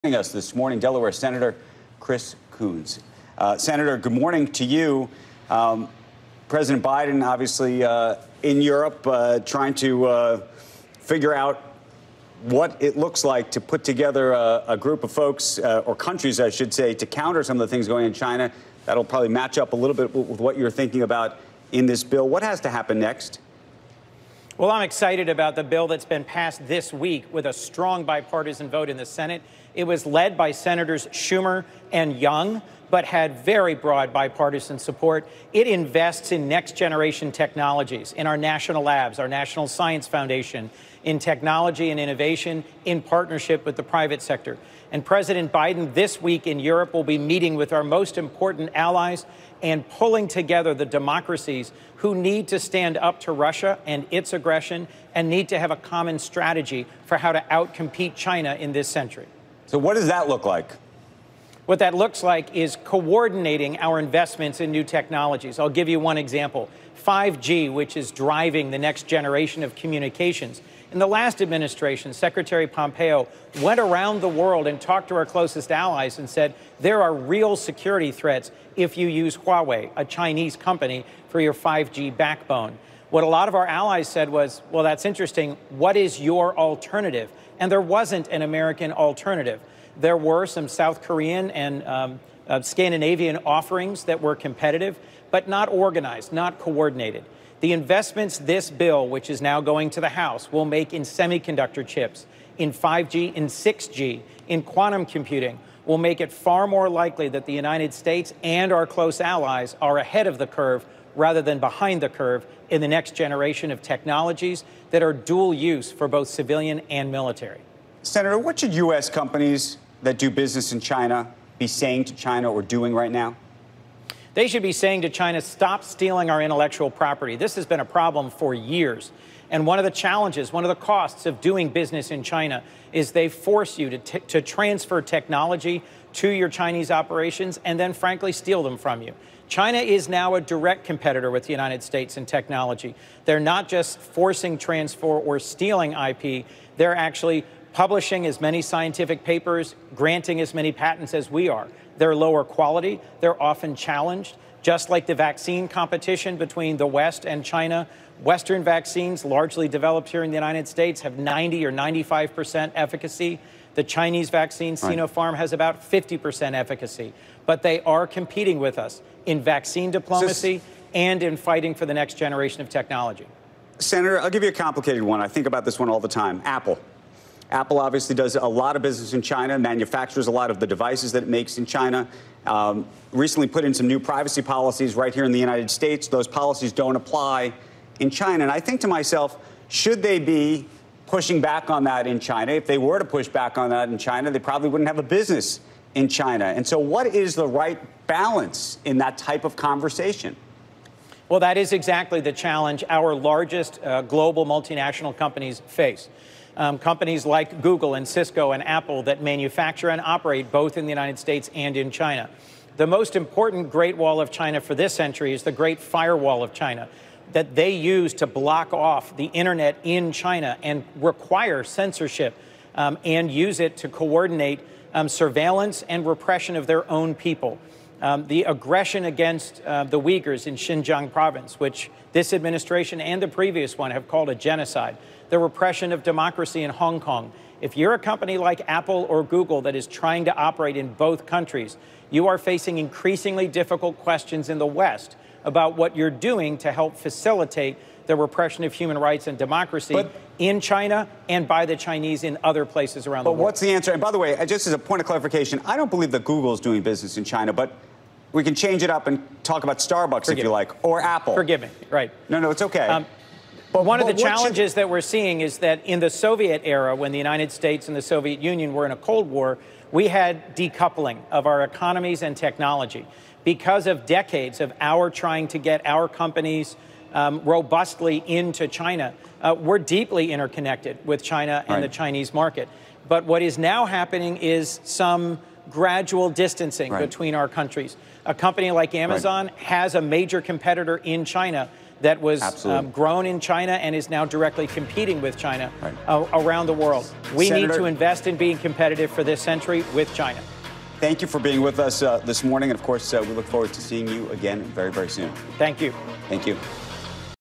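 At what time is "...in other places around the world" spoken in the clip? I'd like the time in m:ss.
4:12.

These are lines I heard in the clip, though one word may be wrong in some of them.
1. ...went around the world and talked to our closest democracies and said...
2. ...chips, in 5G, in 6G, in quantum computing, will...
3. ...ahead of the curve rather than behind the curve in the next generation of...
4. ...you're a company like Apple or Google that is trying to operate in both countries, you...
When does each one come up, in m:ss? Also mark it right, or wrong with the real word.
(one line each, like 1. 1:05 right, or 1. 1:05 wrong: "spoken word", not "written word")
1. 1:13 wrong: "allies", not "democracies"
2. 1:41 right
3. 1:49 right
4. 3:57 right.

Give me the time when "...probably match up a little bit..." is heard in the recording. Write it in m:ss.
0:19.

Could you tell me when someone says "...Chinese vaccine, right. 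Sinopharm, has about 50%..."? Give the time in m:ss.
2:43.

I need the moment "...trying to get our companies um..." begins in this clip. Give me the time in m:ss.
4:35.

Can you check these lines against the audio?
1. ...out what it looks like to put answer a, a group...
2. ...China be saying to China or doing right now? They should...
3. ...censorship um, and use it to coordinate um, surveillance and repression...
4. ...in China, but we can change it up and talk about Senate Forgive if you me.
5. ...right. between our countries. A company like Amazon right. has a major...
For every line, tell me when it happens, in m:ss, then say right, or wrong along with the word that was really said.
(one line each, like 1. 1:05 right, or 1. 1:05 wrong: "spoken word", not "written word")
1. 0:11 wrong: "together", not "answer"
2. 2:00 right
3. 3:41 right
4. 4:17 wrong: "Starbucks", not "Senate"
5. 4:46 right.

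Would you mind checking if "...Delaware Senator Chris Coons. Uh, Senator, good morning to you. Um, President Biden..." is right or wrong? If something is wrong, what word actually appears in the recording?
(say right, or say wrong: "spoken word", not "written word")
right.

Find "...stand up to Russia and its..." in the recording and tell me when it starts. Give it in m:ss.
0:52.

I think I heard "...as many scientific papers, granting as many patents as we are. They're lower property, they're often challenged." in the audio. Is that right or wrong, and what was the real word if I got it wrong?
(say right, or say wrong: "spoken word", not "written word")
wrong: "quality", not "property".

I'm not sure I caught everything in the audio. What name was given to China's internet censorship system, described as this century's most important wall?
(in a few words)
Great Firewall of China.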